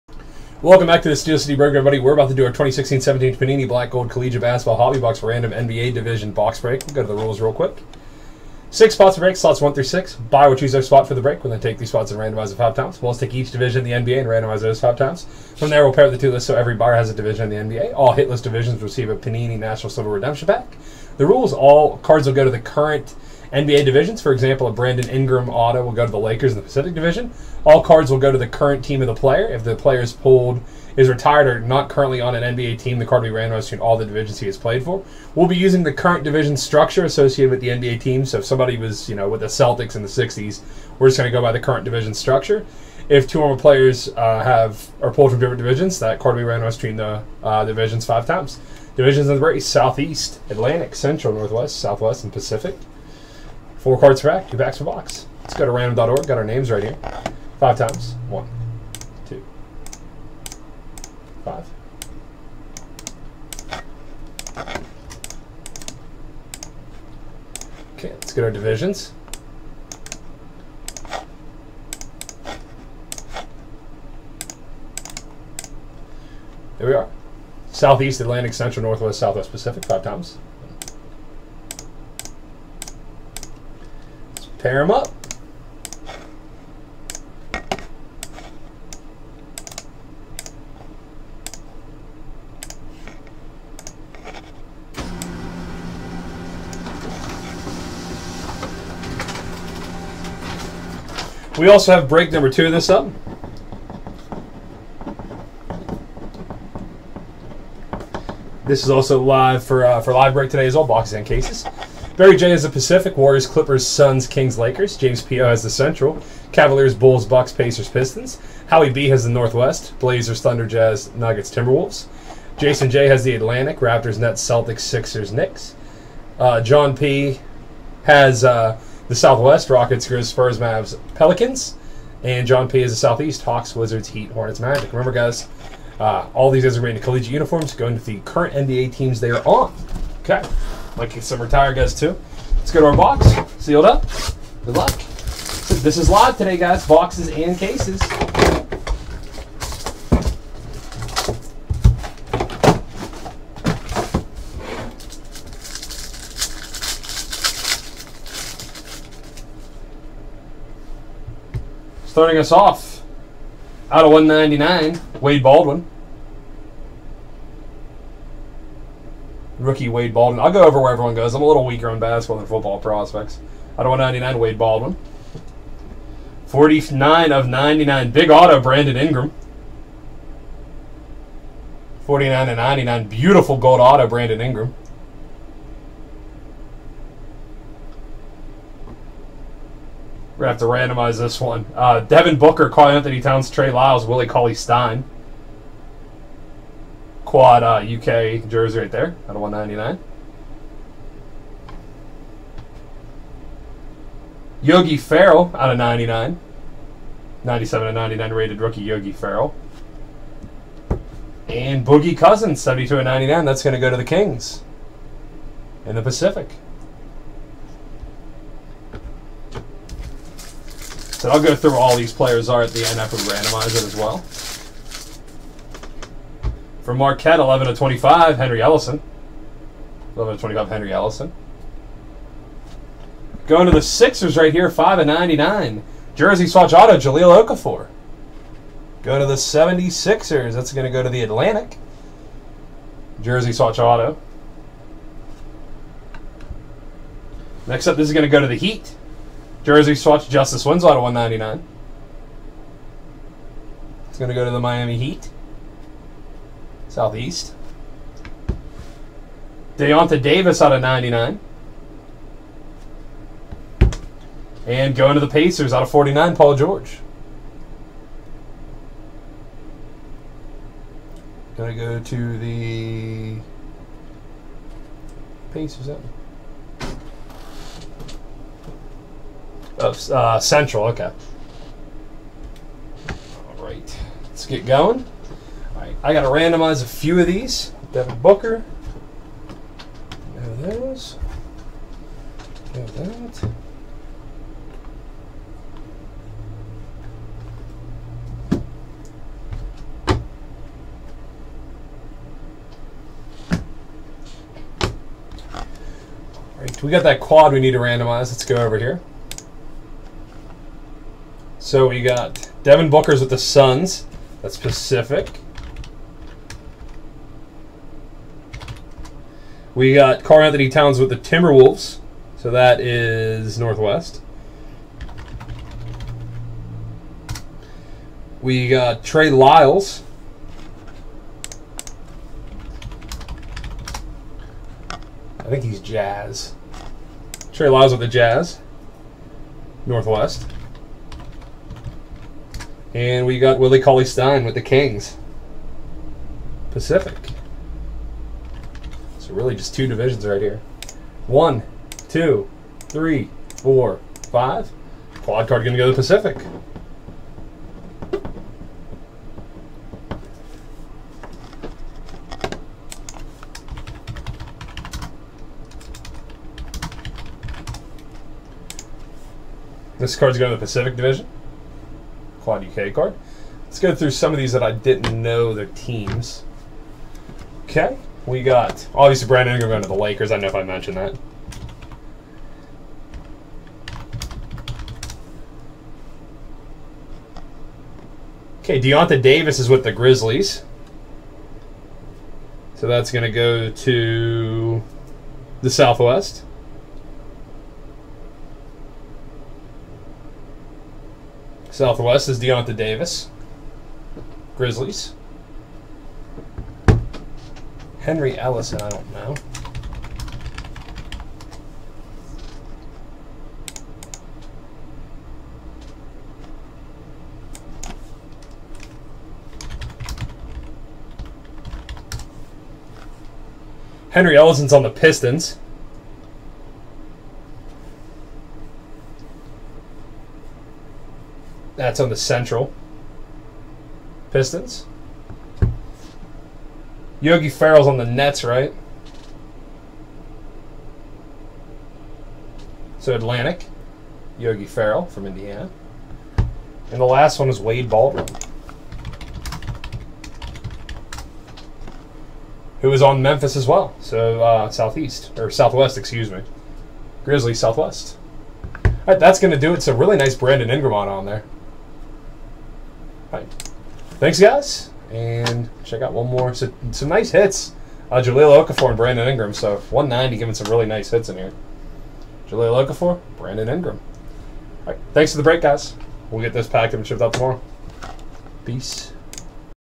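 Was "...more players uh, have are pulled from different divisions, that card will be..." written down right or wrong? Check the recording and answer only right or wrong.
right.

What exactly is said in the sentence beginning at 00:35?
We'll be using the current division structure associated with the NBA team.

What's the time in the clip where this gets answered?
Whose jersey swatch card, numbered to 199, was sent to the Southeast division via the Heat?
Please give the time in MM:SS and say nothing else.
04:10.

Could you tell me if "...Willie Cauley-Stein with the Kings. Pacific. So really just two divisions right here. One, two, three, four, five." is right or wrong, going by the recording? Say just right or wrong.
right.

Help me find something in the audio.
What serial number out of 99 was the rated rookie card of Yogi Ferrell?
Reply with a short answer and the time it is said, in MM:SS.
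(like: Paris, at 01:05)
97, at 03:27.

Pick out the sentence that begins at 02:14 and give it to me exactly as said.
Remember, guys, uh, all these guys are wearing collegiate uniforms, going to the current NBA teams they are on.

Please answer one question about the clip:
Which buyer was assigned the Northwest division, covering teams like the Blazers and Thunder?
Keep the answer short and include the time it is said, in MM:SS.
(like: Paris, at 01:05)
Howie B, at 01:58.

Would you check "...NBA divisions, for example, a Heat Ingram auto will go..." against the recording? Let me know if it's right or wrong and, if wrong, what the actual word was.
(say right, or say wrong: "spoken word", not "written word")
wrong: "Brandon", not "Heat".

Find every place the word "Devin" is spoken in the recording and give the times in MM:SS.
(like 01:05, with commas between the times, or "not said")
03:12, 04:47, 05:12.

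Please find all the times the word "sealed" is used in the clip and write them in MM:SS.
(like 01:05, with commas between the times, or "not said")
02:23.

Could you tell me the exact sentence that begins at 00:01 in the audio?
We're about to do our 2016-17 Panini Black Gold Collegiate Basketball Hobby Box Random NBA Division Box Break.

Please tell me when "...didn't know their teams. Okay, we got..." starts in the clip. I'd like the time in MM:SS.
06:14.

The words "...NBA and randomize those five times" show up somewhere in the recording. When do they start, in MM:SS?
00:14.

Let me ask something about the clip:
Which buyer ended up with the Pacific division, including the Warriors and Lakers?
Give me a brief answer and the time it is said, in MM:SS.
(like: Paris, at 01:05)
Barry J, at 01:52.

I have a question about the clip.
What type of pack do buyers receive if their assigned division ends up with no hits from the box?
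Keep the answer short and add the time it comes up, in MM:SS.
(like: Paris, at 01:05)
Panini National Silver Redemption Pack, at 00:19.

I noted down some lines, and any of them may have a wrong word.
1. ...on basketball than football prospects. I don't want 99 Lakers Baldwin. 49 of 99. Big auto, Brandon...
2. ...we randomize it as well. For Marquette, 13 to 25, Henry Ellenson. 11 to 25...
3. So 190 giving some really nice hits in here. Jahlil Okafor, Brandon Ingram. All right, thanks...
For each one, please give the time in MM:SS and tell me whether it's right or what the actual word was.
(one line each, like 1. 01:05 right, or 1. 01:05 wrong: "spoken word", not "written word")
1. 02:51 wrong: "Wade", not "Lakers"
2. 03:43 wrong: "11", not "13"
3. 07:49 right.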